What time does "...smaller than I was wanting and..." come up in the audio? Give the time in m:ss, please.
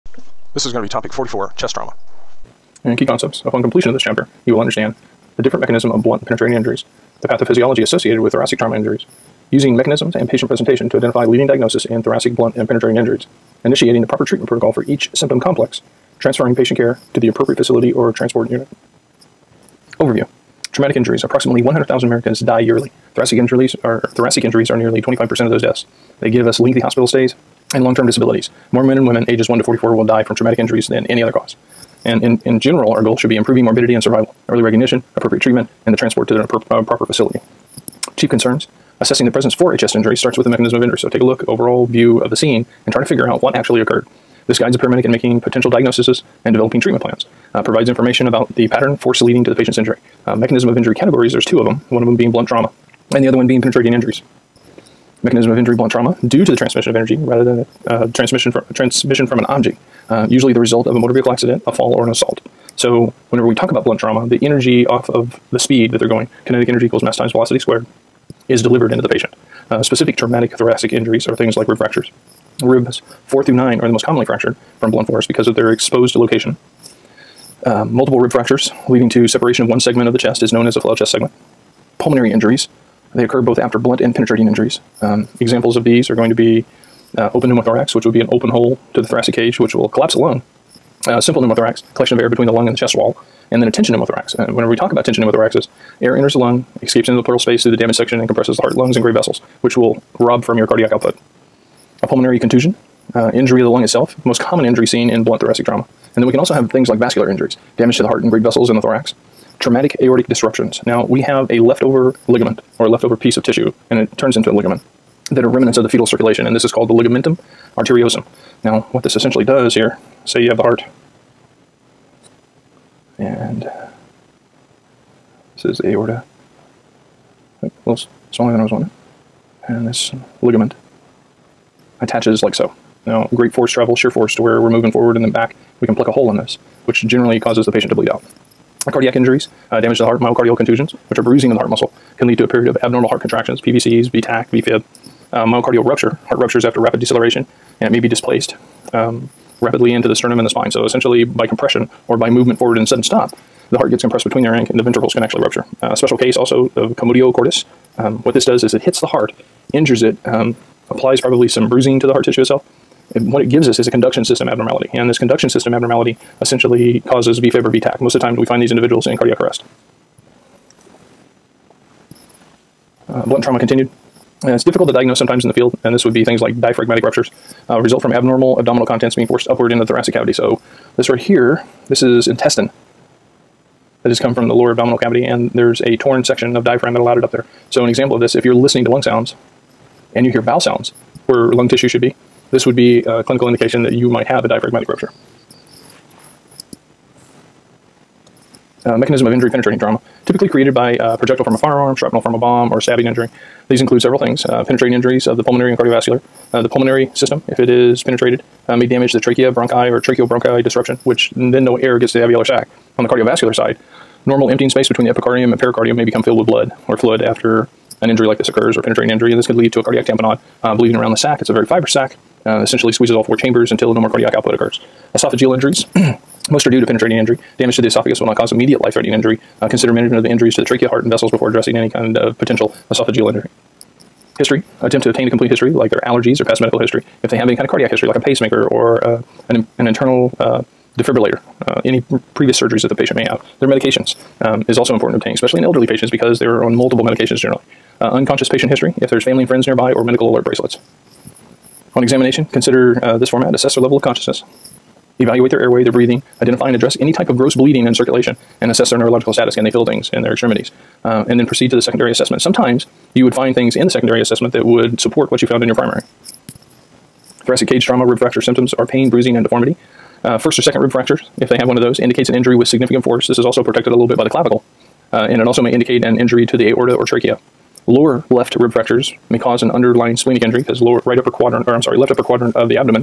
2:08.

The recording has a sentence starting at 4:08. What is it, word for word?
Uh, unconscious patient history, if there's family and friends nearby, or medical alert bracelets.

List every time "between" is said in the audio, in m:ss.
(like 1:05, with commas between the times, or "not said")
1:32, 2:34, 3:34.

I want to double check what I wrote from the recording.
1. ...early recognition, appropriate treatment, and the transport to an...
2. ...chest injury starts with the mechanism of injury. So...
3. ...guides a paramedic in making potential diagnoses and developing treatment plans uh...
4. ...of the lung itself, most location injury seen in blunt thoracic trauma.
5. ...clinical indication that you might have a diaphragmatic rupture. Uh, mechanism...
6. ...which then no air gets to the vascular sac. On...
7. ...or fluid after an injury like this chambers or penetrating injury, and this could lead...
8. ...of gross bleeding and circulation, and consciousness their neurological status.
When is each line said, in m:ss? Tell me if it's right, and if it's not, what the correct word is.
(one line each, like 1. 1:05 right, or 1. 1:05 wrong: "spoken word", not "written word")
1. 0:34 right
2. 0:39 right
3. 0:44 right
4. 1:43 wrong: "common", not "location"
5. 3:13 right
6. 3:31 wrong: "alveolar", not "vascular"
7. 3:36 wrong: "occurs", not "chambers"
8. 4:17 wrong: "assess", not "consciousness".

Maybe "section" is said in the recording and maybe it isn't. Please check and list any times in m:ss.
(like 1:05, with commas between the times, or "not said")
1:37, 3:06.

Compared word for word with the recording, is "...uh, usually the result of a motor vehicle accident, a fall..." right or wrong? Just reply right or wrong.
right.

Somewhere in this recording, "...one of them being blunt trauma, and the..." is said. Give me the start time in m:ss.
0:51.